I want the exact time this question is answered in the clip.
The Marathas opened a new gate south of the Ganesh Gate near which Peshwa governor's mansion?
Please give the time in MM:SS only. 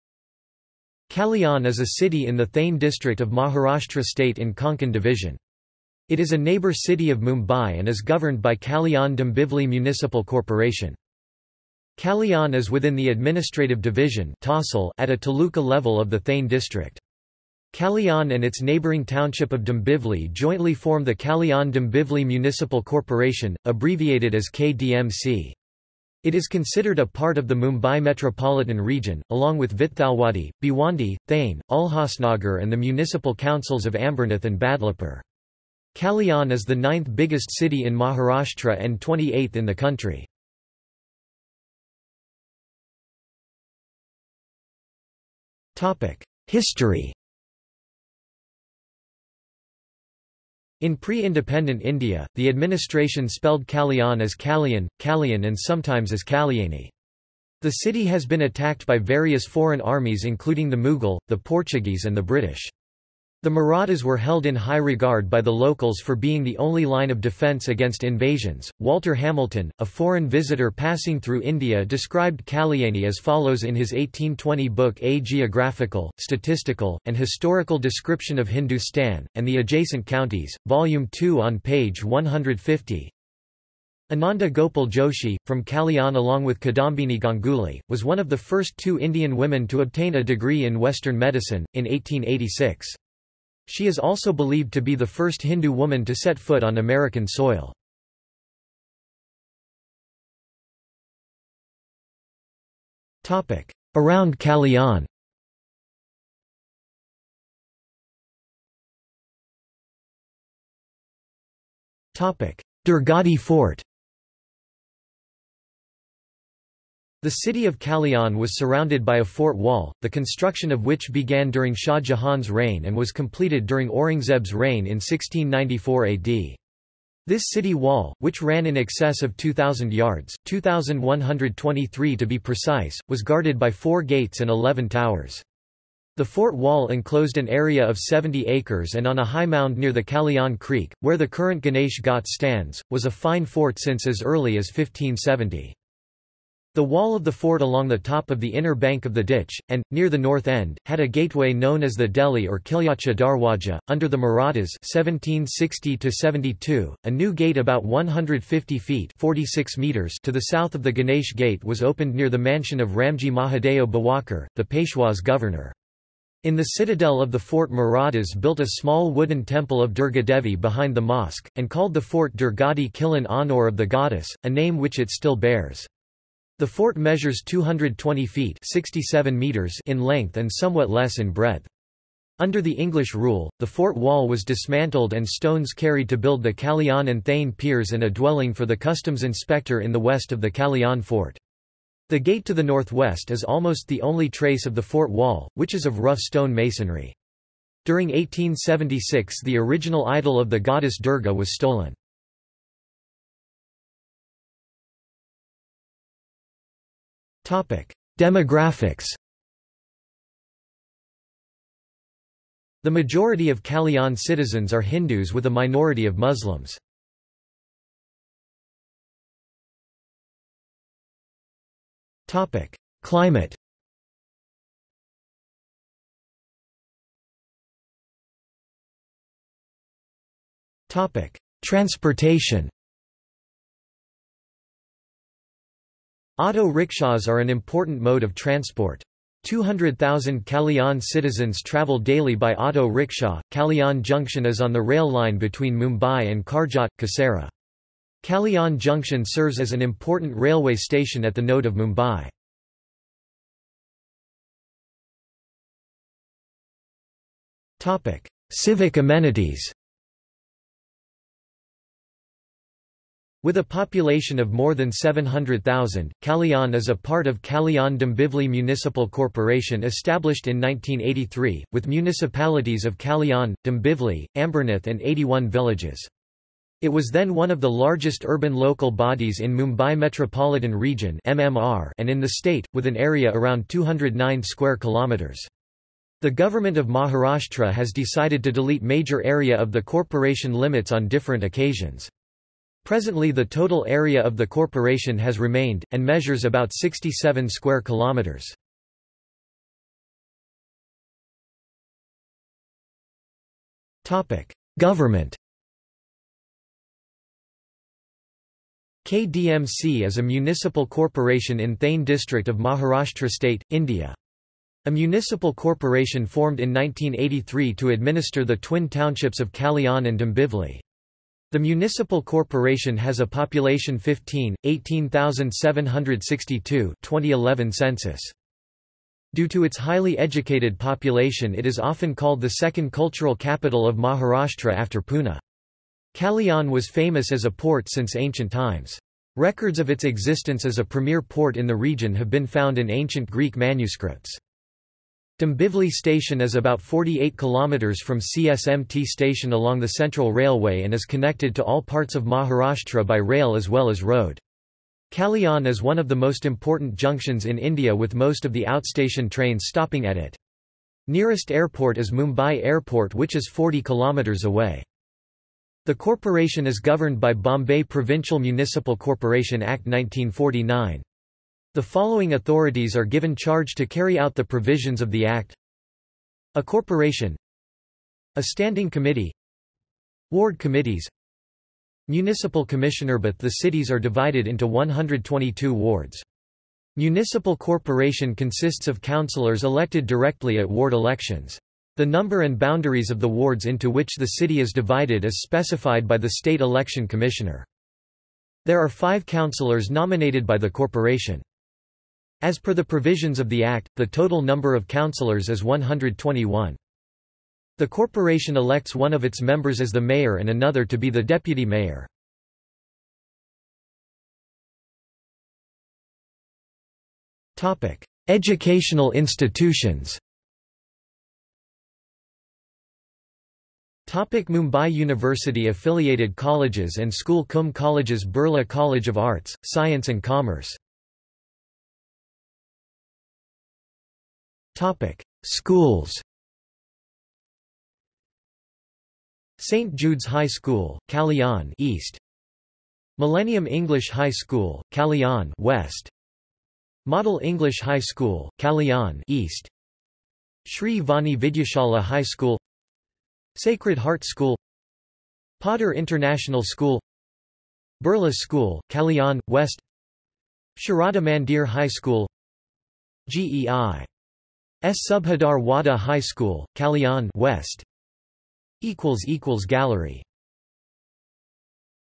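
02:42.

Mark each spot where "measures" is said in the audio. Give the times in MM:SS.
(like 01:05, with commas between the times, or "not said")
02:56, 04:56.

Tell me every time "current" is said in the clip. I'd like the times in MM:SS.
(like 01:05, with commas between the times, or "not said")
02:21.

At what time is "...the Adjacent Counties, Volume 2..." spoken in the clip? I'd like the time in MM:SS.
01:19.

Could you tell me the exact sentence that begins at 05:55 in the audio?
Kalyan is one of the most important junctions in India with most of the outstation trains stopping at it.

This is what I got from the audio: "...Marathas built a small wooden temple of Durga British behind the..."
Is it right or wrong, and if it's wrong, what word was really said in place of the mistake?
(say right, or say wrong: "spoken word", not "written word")
wrong: "Devi", not "British".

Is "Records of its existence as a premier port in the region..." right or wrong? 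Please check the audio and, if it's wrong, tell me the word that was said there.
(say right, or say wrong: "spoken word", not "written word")
right.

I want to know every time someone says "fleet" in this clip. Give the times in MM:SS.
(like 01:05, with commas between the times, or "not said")
not said.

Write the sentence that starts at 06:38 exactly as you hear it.
There are five councillors nominated by the corporation.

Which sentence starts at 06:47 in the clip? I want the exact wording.
The corporation elects one of its members as the mayor and another to be the deputy mayor.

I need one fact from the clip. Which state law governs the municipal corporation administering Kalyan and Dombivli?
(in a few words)
Bombay Provincial Municipal Corporation Act 1949.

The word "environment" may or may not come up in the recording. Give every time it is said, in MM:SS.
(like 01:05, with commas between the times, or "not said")
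not said.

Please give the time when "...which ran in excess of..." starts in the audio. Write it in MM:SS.
02:08.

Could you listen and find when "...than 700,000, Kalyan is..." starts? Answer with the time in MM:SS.
04:24.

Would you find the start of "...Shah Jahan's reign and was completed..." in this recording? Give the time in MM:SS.
02:01.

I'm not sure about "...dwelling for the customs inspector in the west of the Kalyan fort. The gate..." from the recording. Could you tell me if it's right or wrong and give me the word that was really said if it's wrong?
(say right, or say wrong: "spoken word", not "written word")
right.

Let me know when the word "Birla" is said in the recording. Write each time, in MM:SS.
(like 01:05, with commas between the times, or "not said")
07:08, 07:38.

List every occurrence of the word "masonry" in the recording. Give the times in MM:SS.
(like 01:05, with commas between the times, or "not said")
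03:16.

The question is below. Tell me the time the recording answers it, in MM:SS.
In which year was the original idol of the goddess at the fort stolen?
03:18.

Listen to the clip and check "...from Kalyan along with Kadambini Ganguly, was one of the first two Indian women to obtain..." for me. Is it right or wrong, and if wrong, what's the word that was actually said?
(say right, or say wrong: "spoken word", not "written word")
right.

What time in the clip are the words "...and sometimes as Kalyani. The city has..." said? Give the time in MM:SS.
00:55.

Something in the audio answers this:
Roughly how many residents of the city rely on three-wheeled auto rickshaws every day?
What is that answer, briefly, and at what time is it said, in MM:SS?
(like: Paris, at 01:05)
200,000, at 03:59.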